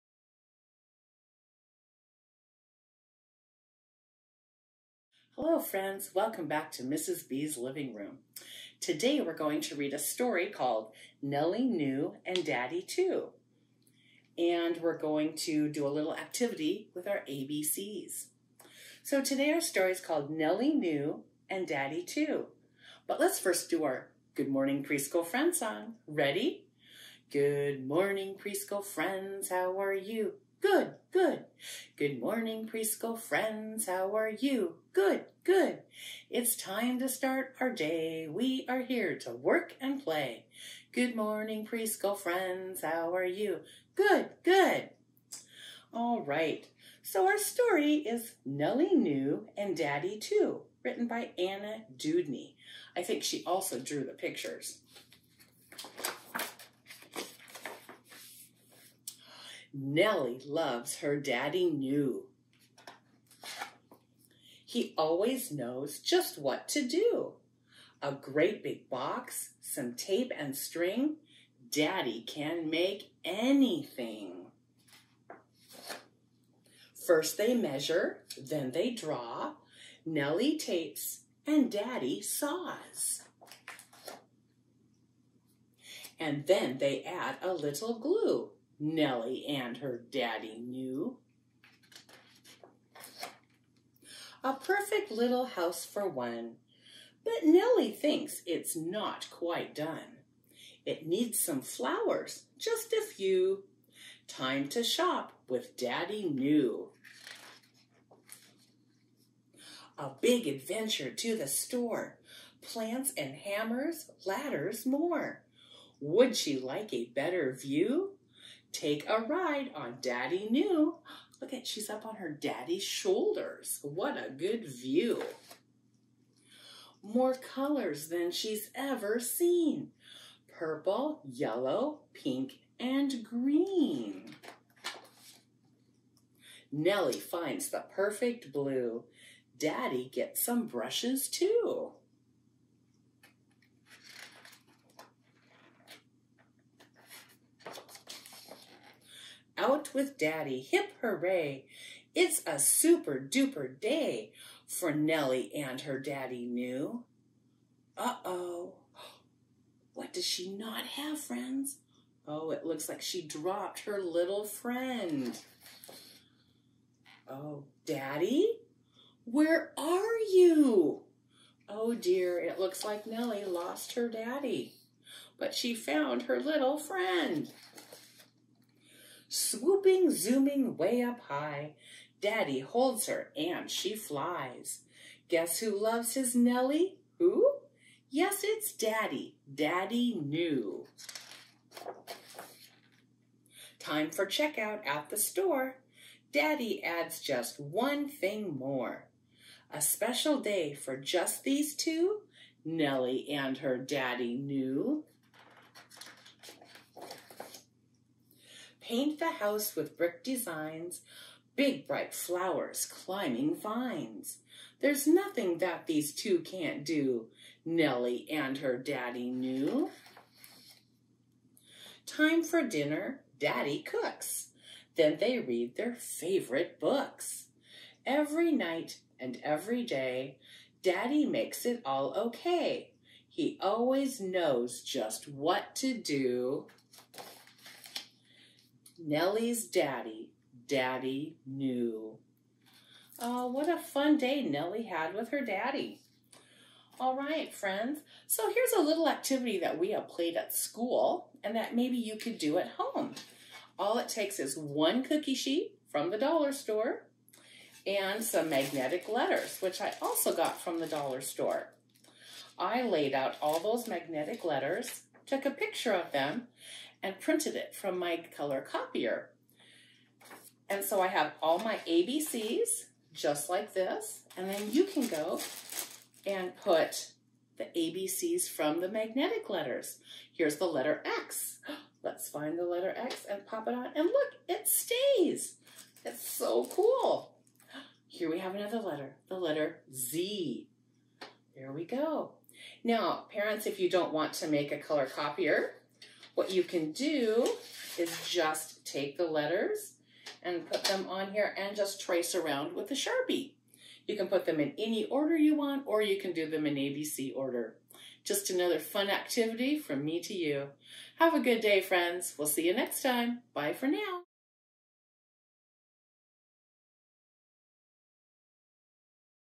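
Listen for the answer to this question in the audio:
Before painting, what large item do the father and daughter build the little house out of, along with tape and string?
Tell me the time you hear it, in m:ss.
1:08.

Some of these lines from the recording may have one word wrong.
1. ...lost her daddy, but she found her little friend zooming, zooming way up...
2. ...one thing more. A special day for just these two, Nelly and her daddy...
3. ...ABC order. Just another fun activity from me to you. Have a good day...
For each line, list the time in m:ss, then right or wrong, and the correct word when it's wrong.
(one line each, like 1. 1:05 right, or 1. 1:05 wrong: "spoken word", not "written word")
1. 2:53 wrong: "swooping", not "zooming"
2. 3:17 right
3. 5:06 right.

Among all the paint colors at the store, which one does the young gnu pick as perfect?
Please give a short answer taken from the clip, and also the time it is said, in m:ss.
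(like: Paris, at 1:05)
blue, at 2:18.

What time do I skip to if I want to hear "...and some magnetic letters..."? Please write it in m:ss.
4:17.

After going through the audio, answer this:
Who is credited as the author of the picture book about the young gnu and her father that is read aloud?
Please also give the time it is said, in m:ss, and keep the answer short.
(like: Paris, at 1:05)
Anna Dewdney, at 0:51.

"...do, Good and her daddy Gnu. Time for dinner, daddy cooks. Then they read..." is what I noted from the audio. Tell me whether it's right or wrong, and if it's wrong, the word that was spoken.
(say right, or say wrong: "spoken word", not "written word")
wrong: "Nelly", not "Good".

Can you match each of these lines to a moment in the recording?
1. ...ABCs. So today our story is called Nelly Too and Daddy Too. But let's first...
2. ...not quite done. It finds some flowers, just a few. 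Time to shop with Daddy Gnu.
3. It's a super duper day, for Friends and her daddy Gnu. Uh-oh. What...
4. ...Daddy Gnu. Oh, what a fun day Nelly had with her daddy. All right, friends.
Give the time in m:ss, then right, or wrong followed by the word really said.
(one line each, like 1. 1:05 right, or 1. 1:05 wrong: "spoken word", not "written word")
1. 0:17 wrong: "Gnu", not "Too"
2. 1:38 wrong: "needs", not "finds"
3. 2:32 wrong: "Nelly", not "Friends"
4. 4:00 right.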